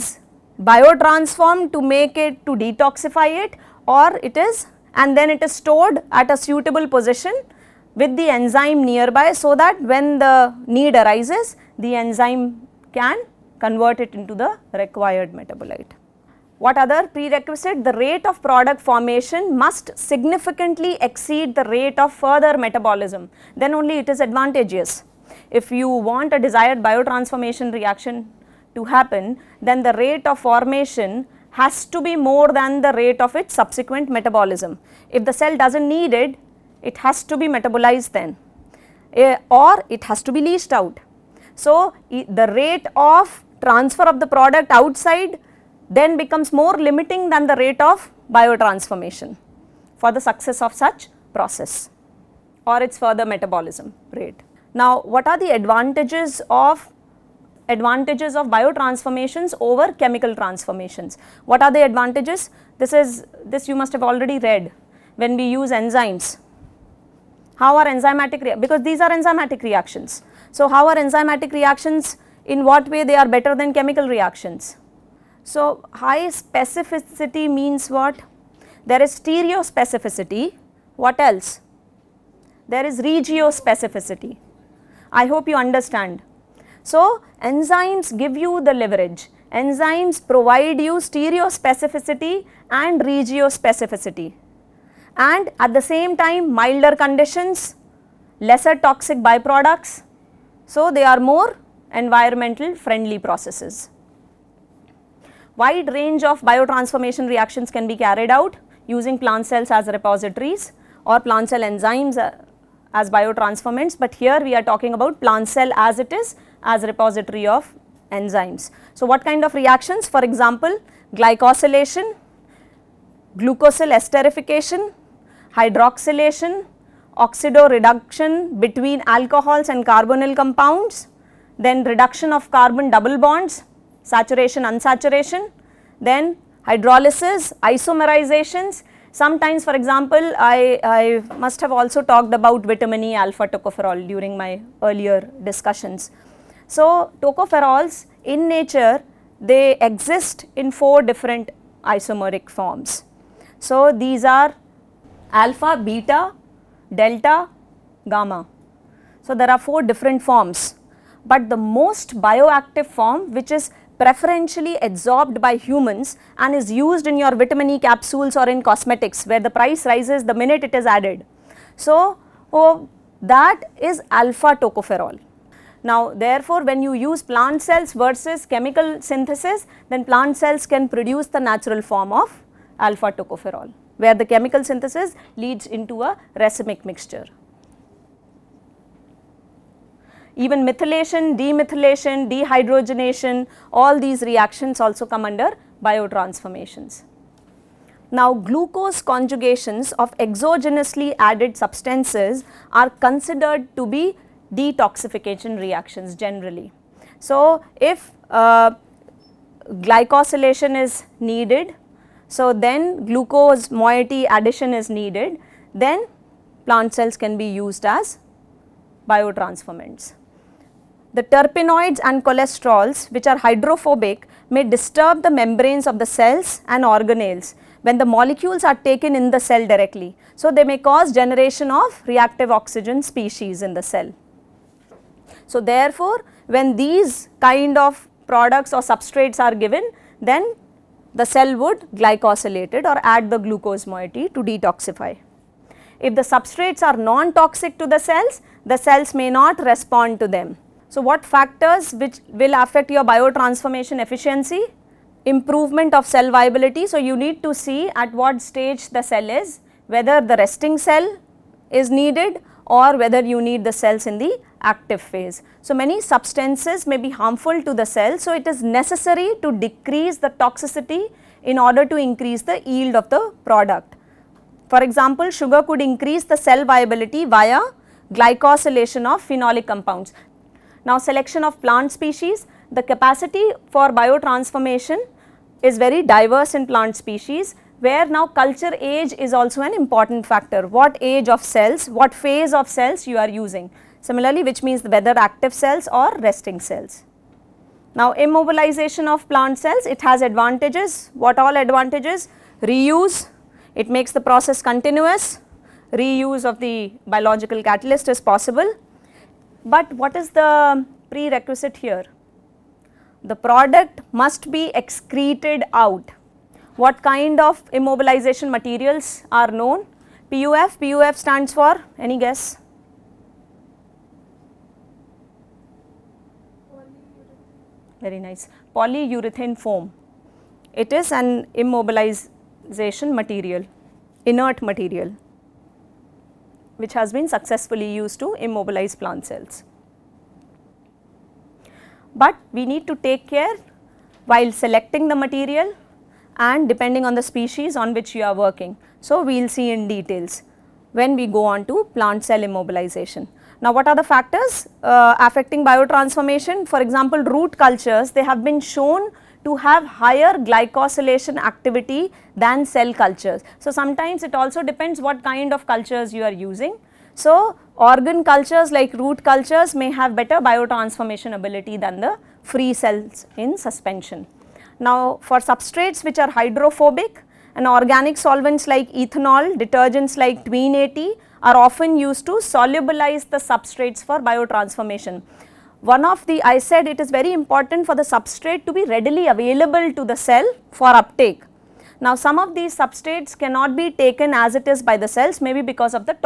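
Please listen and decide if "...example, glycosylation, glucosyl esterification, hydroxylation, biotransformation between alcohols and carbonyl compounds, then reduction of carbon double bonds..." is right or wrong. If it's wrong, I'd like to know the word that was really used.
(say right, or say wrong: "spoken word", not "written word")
wrong: "oxidoreduction", not "biotransformation".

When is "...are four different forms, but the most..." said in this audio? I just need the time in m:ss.
2:39.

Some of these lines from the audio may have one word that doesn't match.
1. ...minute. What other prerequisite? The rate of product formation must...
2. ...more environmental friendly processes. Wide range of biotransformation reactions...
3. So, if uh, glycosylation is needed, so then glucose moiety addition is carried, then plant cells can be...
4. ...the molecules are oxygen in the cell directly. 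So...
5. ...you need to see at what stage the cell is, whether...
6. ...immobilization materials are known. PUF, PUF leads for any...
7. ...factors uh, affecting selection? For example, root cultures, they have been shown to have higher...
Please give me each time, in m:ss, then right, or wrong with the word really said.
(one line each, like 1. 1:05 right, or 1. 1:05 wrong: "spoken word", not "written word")
1. 0:15 wrong: "metabolite", not "minute"
2. 1:41 right
3. 3:27 wrong: "needed", not "carried"
4. 3:47 wrong: "taken", not "oxygen"
5. 4:16 right
6. 5:17 wrong: "stands", not "leads"
7. 5:54 wrong: "biotransformation", not "selection".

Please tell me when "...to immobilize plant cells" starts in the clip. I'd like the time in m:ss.
5:38.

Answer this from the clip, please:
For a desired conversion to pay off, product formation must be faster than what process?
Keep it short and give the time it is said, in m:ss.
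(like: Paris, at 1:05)
subsequent metabolism, at 0:32.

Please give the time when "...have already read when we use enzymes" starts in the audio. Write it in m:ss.
1:03.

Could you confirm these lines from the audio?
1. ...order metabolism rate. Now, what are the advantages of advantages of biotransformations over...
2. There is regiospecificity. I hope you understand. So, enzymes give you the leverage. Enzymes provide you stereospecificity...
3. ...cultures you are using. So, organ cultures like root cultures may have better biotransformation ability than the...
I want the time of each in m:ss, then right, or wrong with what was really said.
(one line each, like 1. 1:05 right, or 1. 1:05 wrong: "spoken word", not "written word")
1. 0:52 wrong: "further", not "order"
2. 1:22 right
3. 6:05 right.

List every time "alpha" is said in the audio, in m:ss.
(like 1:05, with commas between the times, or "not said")
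2:23, 2:35, 2:54, 3:02.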